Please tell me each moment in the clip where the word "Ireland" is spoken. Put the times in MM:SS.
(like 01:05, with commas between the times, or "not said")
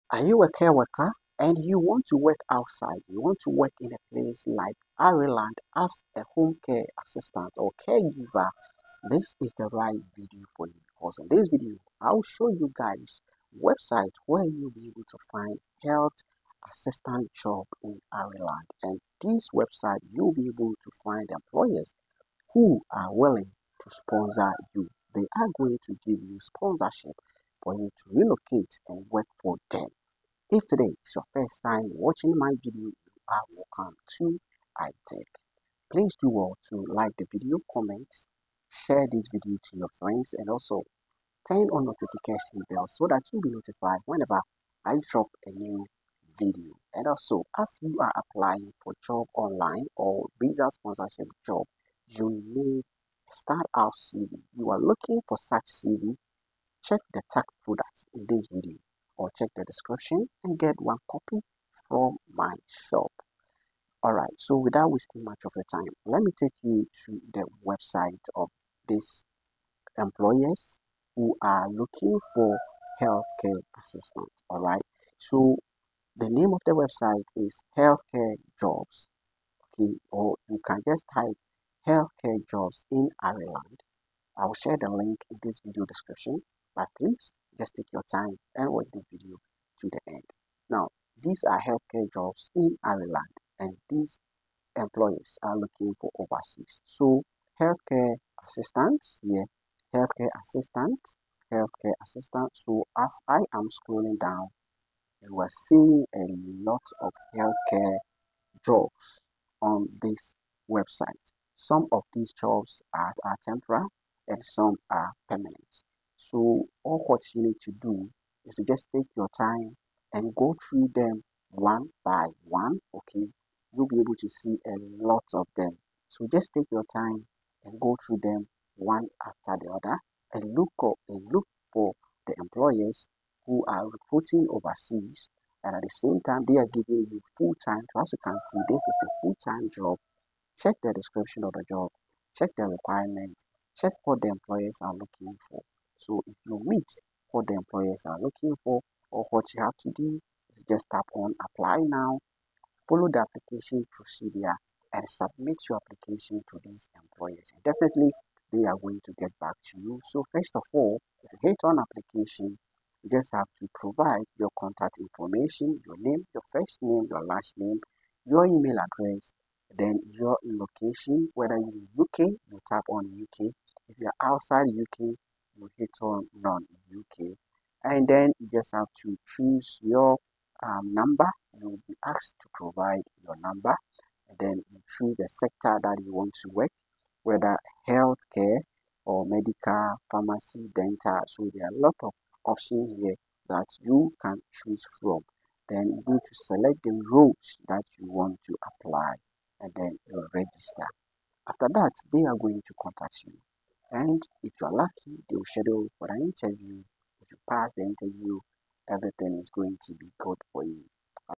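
00:04, 00:18, 01:23, 01:32.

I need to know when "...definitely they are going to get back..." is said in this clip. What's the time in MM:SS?
02:37.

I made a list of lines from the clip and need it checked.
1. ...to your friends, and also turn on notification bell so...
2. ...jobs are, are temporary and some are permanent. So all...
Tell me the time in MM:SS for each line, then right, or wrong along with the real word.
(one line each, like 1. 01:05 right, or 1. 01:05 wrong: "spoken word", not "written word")
1. 00:39 right
2. 01:52 right.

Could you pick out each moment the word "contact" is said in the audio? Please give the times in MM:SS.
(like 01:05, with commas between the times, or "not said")
02:44, 03:22.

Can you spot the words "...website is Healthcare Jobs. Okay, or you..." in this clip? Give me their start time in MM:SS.
01:16.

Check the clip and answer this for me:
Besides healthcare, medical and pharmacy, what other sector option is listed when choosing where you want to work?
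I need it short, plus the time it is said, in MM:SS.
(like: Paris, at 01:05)
Dental, at 03:10.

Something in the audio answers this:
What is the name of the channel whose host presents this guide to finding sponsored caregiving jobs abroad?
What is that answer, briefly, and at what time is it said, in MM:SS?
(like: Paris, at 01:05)
Ike Tech, at 00:34.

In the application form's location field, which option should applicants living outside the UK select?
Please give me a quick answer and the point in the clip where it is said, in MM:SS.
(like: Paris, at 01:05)
None in UK, at 02:56.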